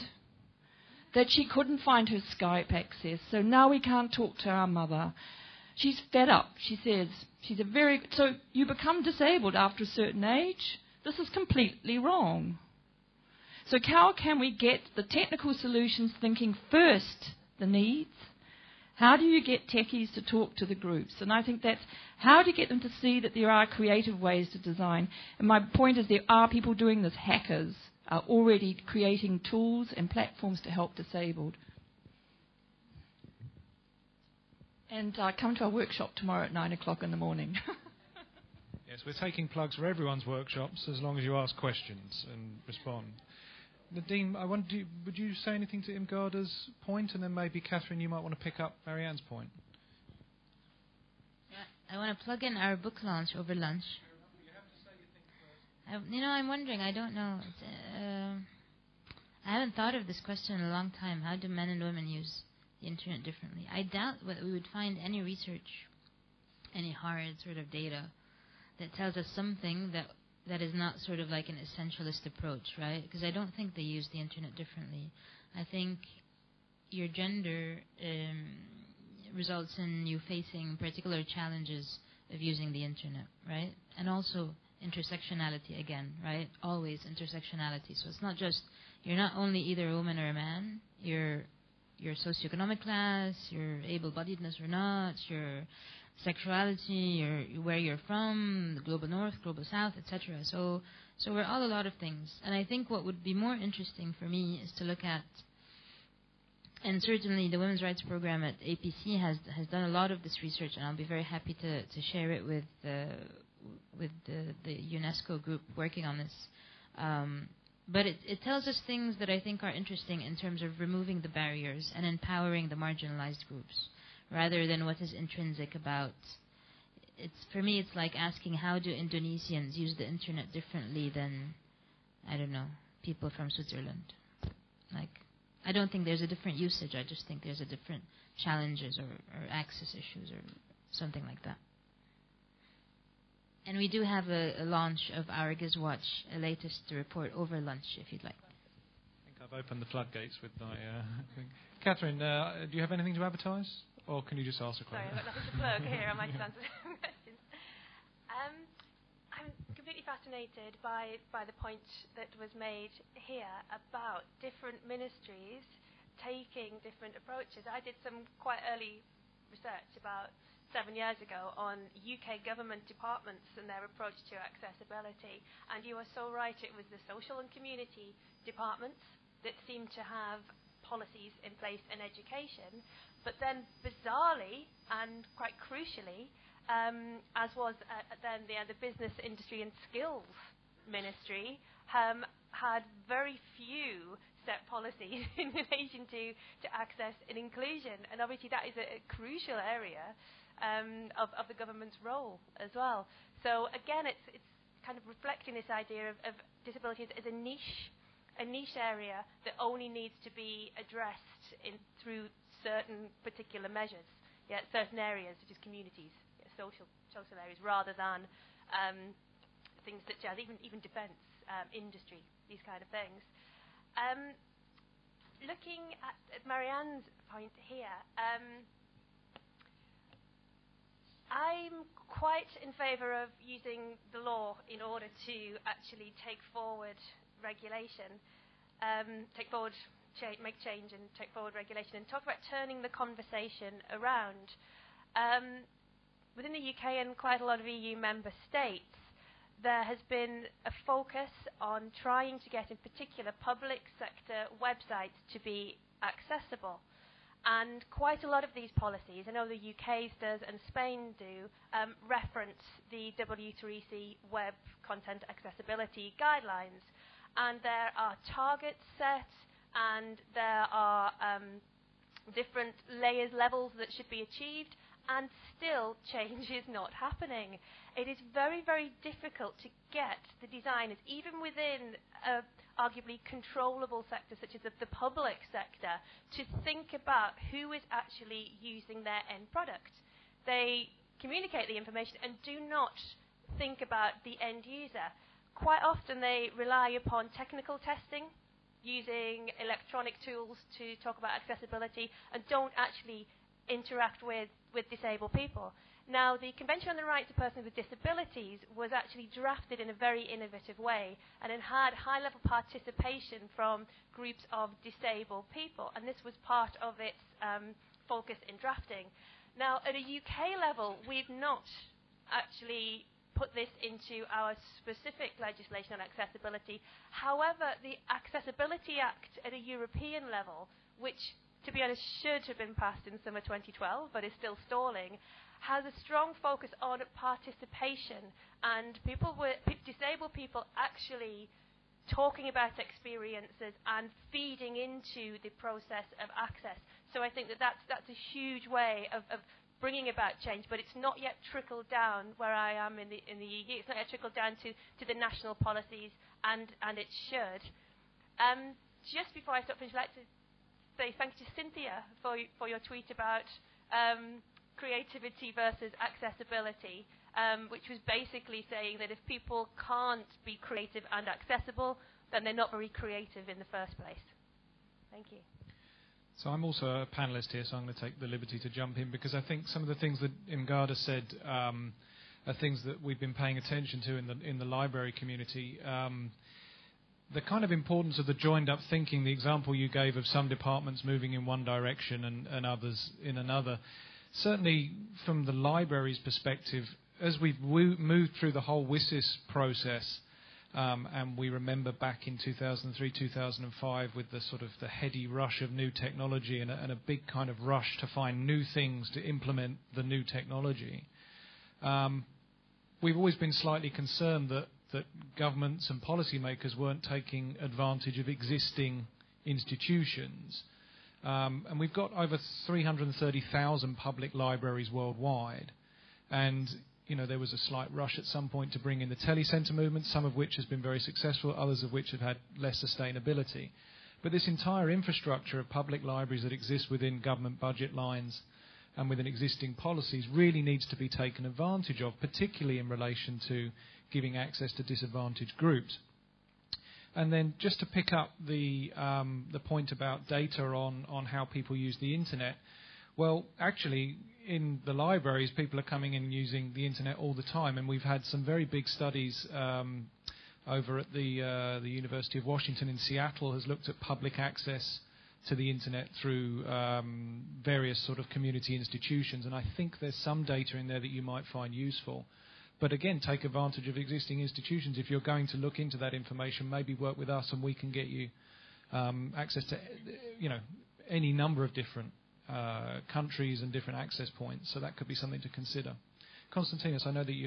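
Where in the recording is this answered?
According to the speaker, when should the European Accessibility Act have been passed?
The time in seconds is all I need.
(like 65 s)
333 s.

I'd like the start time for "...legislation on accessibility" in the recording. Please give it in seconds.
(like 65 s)
325 s.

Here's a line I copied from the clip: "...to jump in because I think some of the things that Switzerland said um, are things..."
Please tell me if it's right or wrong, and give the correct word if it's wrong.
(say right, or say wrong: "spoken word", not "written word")
wrong: "Irmgarda", not "Switzerland".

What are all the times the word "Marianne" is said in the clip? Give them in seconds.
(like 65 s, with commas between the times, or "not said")
48 s, 226 s.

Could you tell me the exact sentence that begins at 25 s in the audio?
And my point is there are people doing this, hackers are already creating tools and platforms to help disabled.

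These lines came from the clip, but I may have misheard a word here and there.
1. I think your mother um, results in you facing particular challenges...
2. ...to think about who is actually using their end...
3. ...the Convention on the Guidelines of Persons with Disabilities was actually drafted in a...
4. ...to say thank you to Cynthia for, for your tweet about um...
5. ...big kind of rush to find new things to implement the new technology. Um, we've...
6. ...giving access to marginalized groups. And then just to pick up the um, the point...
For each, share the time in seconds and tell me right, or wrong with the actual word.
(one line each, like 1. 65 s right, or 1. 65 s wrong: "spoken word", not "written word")
1. 75 s wrong: "gender", not "mother"
2. 286 s right
3. 306 s wrong: "Rights", not "Guidelines"
4. 360 s right
5. 406 s right
6. 444 s wrong: "disadvantaged", not "marginalized".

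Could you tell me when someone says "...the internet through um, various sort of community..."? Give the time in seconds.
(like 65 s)
465 s.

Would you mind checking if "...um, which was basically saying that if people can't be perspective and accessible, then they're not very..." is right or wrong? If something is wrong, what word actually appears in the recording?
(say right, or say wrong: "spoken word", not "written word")
wrong: "creative", not "perspective".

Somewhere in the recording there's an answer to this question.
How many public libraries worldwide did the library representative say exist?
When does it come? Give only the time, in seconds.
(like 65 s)
422 s.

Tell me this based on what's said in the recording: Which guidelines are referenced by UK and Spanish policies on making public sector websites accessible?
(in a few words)
W3C Web Content Accessibility Guidelines.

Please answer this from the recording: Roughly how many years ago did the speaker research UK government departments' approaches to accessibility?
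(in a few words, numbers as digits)
7.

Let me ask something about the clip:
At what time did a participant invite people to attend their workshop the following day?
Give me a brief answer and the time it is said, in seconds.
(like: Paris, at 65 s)
9 o'clock in the morning, at 36 s.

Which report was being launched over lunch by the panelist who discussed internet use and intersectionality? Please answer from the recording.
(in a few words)
GISWatch.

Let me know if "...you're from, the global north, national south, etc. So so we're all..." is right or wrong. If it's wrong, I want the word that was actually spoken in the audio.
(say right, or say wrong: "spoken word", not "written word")
wrong: "global", not "national".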